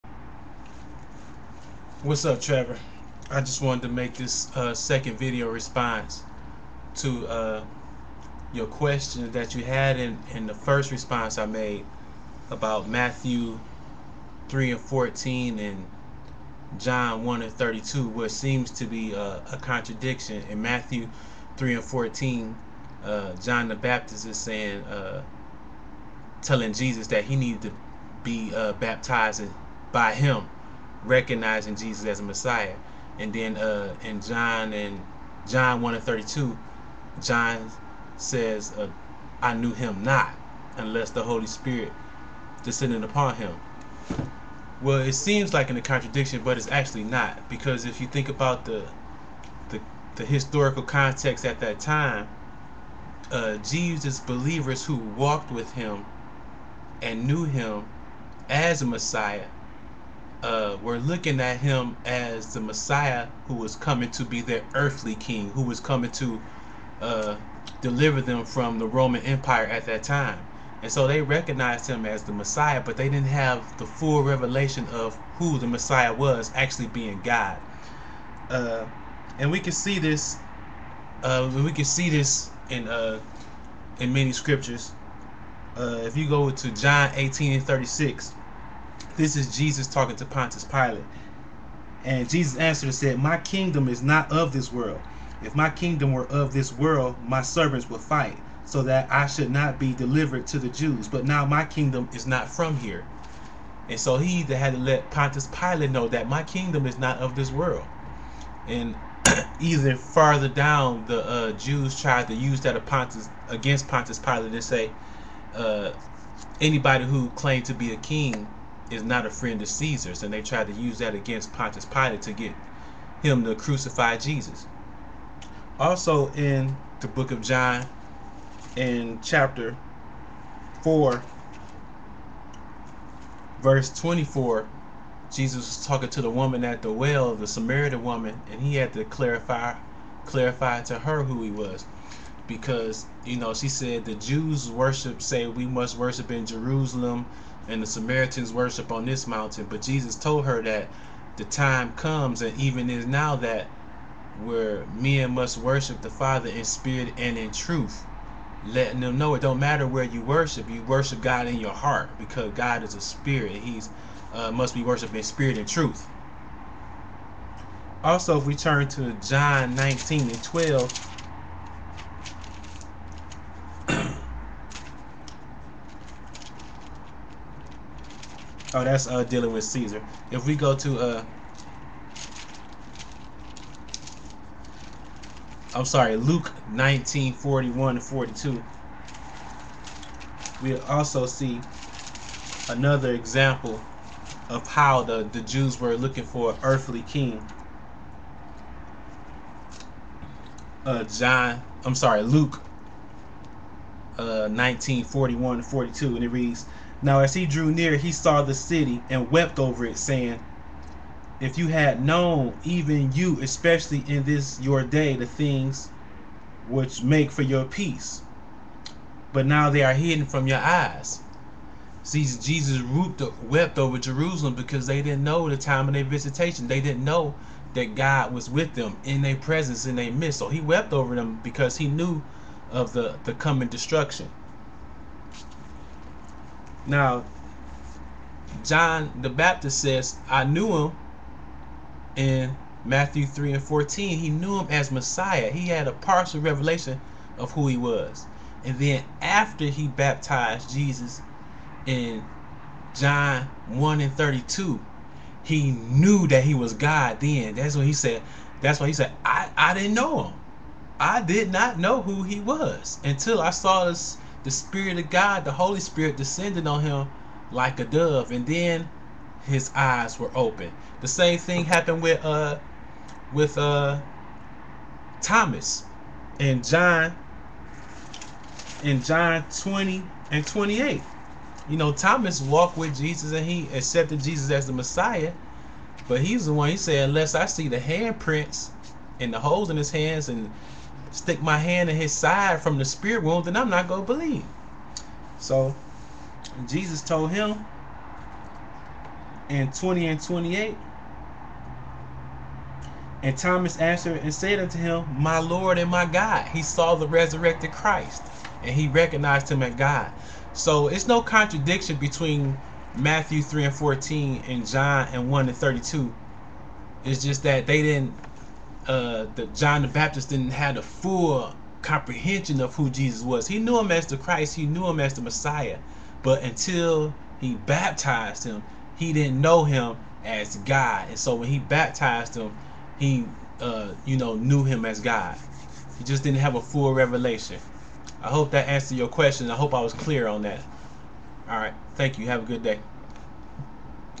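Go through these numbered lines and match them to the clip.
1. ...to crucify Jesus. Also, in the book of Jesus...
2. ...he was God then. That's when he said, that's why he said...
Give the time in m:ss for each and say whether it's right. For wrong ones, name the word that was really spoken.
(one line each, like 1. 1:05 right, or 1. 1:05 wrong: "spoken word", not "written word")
1. 2:03 wrong: "John", not "Jesus"
2. 4:16 right.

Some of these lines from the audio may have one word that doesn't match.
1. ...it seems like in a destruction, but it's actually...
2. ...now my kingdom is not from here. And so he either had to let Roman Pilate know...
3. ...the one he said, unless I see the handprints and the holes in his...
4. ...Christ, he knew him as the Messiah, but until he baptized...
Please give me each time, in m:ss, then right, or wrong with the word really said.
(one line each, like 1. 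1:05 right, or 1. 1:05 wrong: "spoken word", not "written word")
1. 0:44 wrong: "contradiction", not "destruction"
2. 1:41 wrong: "Pontius", not "Roman"
3. 4:46 right
4. 5:24 right.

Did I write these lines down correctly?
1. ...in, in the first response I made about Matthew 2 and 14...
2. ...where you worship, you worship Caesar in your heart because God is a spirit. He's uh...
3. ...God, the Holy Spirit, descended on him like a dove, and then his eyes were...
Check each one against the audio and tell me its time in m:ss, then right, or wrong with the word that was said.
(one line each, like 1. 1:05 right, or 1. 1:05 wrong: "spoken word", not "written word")
1. 0:09 wrong: "3", not "2"
2. 2:39 wrong: "God", not "Caesar"
3. 4:25 right.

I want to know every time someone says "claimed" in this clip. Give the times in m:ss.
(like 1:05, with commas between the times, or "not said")
1:57.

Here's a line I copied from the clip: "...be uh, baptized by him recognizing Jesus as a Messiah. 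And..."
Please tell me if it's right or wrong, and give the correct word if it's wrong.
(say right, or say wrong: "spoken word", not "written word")
right.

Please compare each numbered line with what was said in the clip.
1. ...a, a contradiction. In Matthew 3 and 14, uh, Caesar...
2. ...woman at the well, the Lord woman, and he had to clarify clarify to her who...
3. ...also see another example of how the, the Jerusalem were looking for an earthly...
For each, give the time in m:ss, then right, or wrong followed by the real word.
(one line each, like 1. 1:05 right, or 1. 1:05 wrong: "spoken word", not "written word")
1. 0:19 wrong: "John", not "Caesar"
2. 2:16 wrong: "Samaritan", not "Lord"
3. 3:10 wrong: "Jews", not "Jerusalem".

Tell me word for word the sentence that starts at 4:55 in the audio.
So Jesus told him in 20 and 28, and Thomas answered and said unto him, My Lord and my God.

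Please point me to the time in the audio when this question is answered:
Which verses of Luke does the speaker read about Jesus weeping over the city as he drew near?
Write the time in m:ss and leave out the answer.
3:06.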